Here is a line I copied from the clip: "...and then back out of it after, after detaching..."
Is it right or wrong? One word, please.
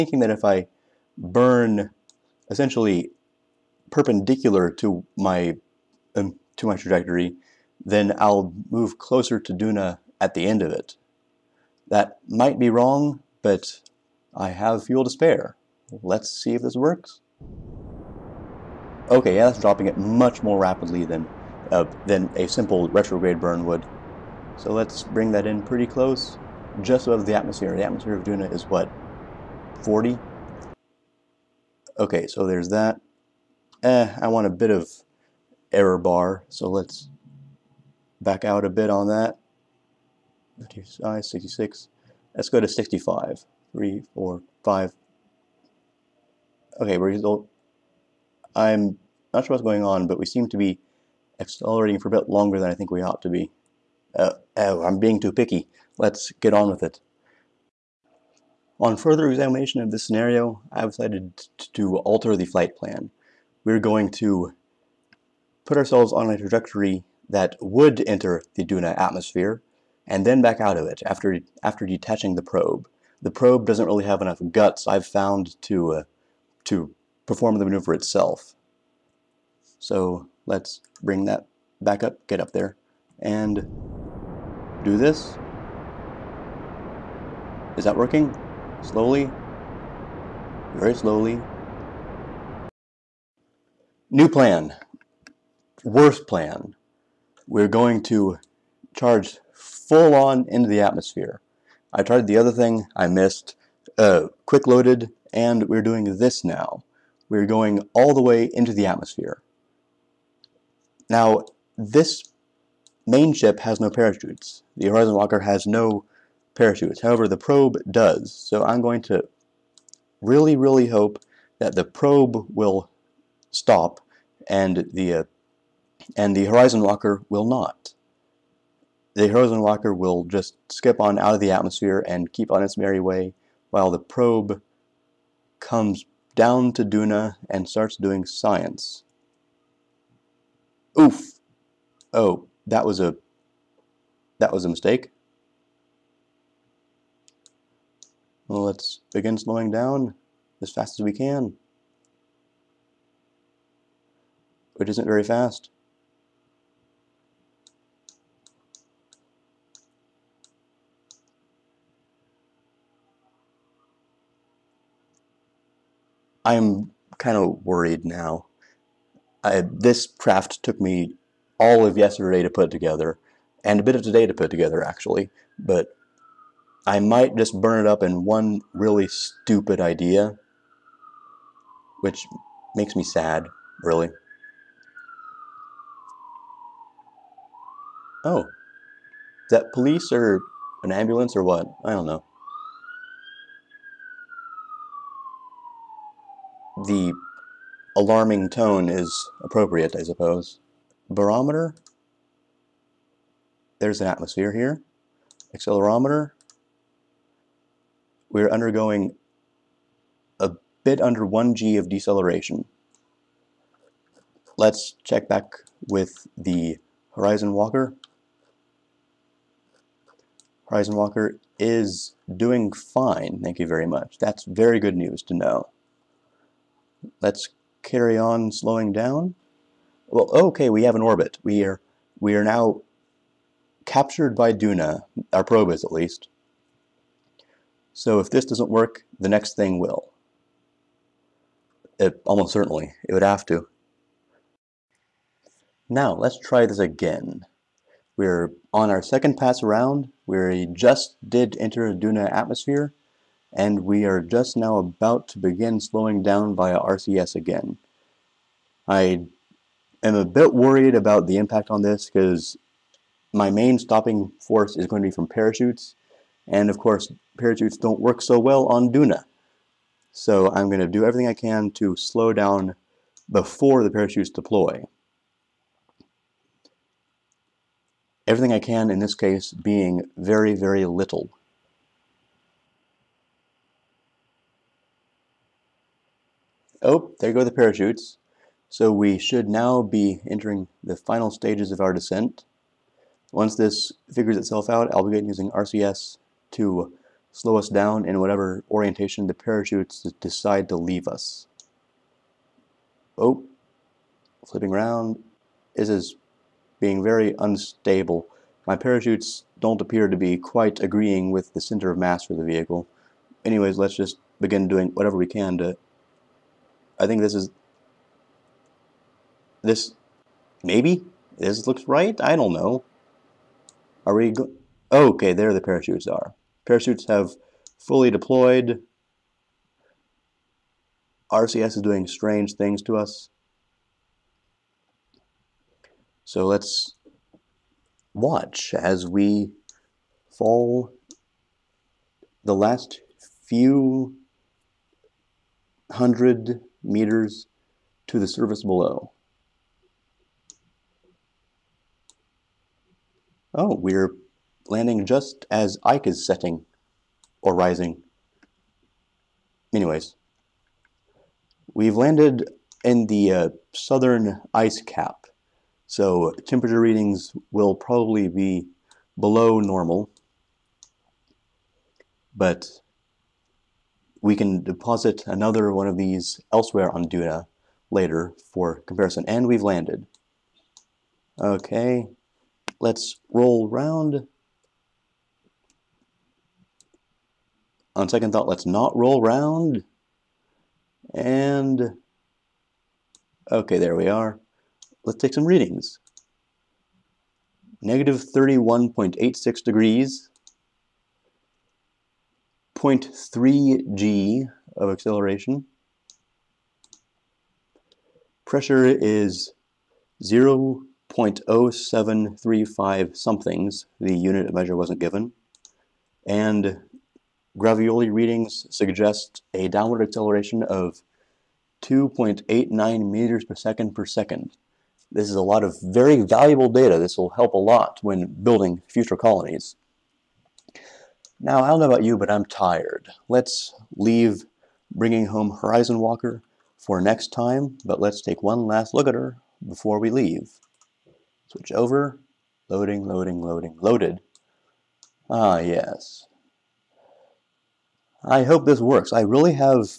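right.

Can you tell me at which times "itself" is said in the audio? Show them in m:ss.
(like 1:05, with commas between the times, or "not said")
1:17, 4:54.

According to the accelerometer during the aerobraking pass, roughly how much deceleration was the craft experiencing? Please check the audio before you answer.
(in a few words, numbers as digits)
a bit under 1 g.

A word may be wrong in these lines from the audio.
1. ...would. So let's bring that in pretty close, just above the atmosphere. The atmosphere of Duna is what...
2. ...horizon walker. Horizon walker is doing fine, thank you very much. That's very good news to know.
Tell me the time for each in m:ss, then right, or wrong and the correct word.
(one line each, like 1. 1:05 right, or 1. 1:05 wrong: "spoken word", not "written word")
1. 0:23 right
2. 3:37 right.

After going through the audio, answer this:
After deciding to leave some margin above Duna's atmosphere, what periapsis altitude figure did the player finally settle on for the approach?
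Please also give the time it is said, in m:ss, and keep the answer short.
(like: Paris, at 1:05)
65, at 0:42.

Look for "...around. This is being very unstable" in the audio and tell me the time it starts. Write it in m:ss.
5:04.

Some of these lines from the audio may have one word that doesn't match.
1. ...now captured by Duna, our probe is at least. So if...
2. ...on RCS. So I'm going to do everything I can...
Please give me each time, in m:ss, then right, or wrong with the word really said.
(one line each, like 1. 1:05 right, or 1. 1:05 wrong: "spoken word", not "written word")
1. 3:52 right
2. 4:28 wrong: "Duna", not "RCS".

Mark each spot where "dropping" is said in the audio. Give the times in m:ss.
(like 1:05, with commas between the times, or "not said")
0:19.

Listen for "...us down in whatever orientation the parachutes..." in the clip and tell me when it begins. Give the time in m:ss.
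4:57.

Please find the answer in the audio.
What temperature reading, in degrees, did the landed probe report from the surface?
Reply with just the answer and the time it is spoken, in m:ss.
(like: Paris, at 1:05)
-31.86, at 6:37.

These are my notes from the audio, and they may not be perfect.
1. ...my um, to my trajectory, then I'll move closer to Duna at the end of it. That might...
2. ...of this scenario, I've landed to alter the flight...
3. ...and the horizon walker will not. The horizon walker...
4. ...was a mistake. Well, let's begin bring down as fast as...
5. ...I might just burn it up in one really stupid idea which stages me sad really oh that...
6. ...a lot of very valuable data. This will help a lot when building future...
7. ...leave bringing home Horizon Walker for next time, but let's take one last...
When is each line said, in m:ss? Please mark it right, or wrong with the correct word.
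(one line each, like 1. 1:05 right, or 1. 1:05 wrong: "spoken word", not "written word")
1. 0:05 right
2. 0:59 wrong: "decided", not "landed"
3. 2:06 right
4. 2:24 wrong: "slowing", not "bring"
5. 2:56 wrong: "makes", not "stages"
6. 7:05 right
7. 7:13 right.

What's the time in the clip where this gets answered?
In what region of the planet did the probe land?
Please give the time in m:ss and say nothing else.
6:03.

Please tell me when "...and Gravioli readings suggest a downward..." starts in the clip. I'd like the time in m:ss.
6:56.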